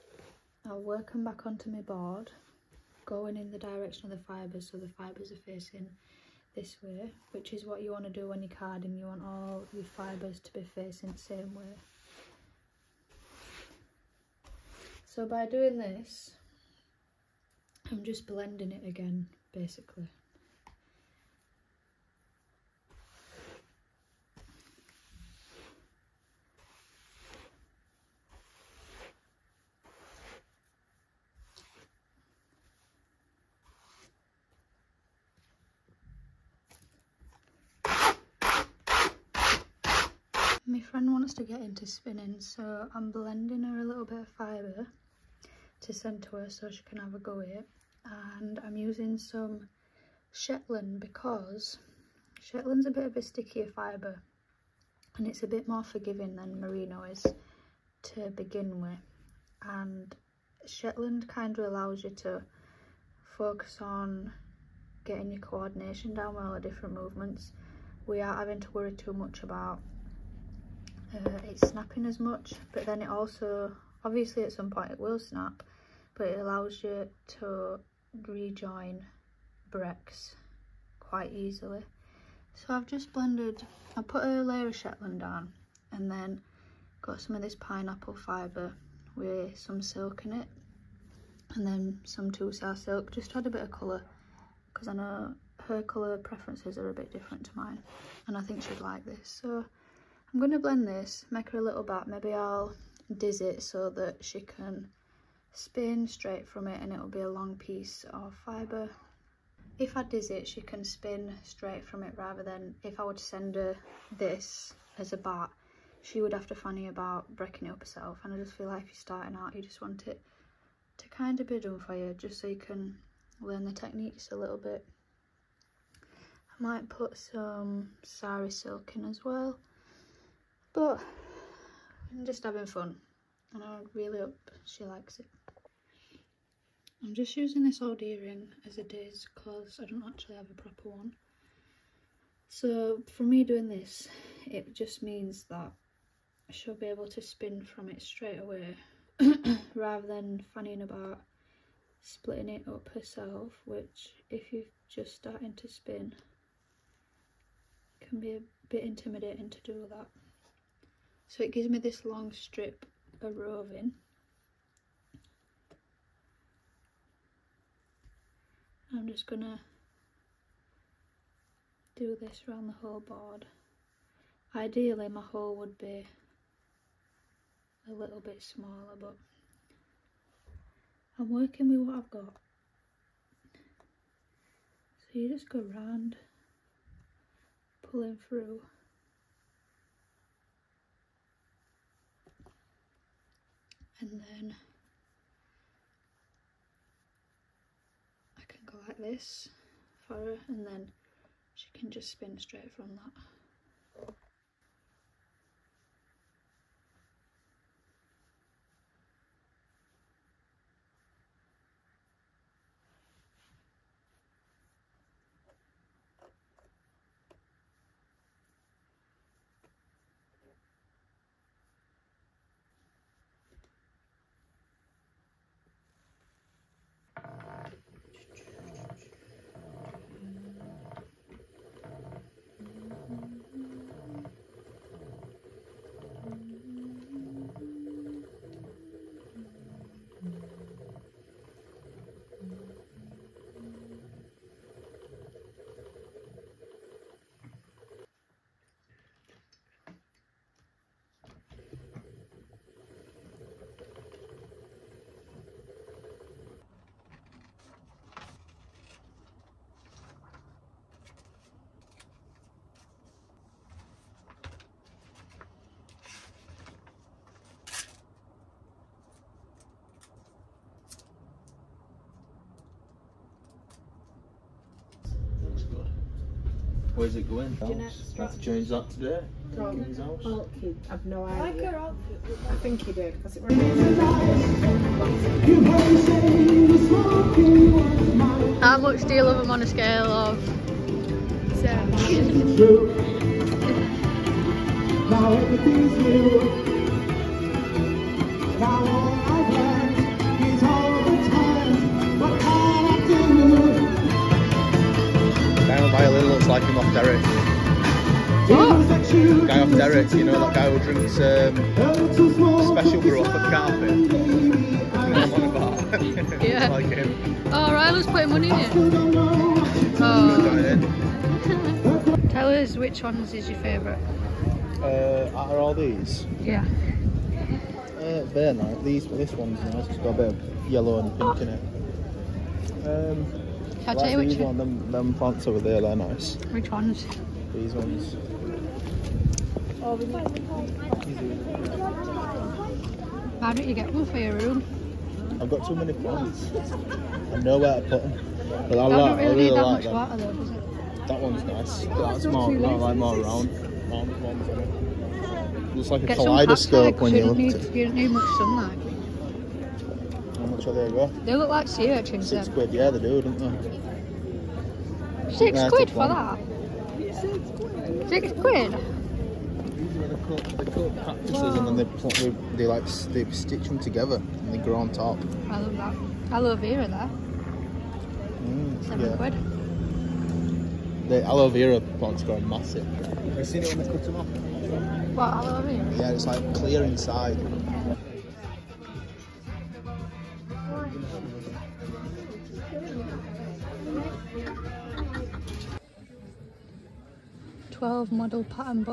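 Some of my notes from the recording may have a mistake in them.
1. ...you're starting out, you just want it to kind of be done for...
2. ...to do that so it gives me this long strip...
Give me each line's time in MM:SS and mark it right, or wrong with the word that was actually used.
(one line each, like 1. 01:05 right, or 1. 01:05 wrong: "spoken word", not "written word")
1. 01:58 right
2. 02:39 right.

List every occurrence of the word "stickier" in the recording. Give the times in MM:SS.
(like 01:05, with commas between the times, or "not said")
00:53.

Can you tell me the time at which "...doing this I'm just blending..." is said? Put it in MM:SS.
00:15.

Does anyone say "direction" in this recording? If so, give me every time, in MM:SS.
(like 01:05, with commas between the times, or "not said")
00:03.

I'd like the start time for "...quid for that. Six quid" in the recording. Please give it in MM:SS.
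06:05.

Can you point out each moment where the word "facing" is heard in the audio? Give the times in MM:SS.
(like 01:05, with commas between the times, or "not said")
00:05, 00:10.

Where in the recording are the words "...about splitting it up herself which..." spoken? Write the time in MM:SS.
02:30.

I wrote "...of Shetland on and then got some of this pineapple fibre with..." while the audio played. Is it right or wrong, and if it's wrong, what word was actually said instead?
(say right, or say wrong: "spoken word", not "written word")
right.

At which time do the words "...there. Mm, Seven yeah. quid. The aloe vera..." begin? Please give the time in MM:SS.
06:16.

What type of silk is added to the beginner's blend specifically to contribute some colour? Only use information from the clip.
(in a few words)
Tussar silk.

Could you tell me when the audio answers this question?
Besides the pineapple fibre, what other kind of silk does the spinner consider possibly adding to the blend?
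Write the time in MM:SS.
02:08.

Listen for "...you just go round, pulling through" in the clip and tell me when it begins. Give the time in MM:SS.
03:05.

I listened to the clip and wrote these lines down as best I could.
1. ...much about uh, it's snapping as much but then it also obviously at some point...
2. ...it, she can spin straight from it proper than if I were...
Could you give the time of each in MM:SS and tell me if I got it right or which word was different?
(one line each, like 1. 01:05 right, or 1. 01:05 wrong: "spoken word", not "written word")
1. 01:09 right
2. 01:50 wrong: "rather", not "proper".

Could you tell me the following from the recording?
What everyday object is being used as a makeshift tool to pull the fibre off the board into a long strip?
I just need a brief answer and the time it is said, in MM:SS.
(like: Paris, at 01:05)
old earring, at 02:17.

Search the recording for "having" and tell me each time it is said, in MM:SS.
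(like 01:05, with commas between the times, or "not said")
01:08, 02:12.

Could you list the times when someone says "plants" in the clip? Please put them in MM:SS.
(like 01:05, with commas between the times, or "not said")
05:35, 05:45, 06:21.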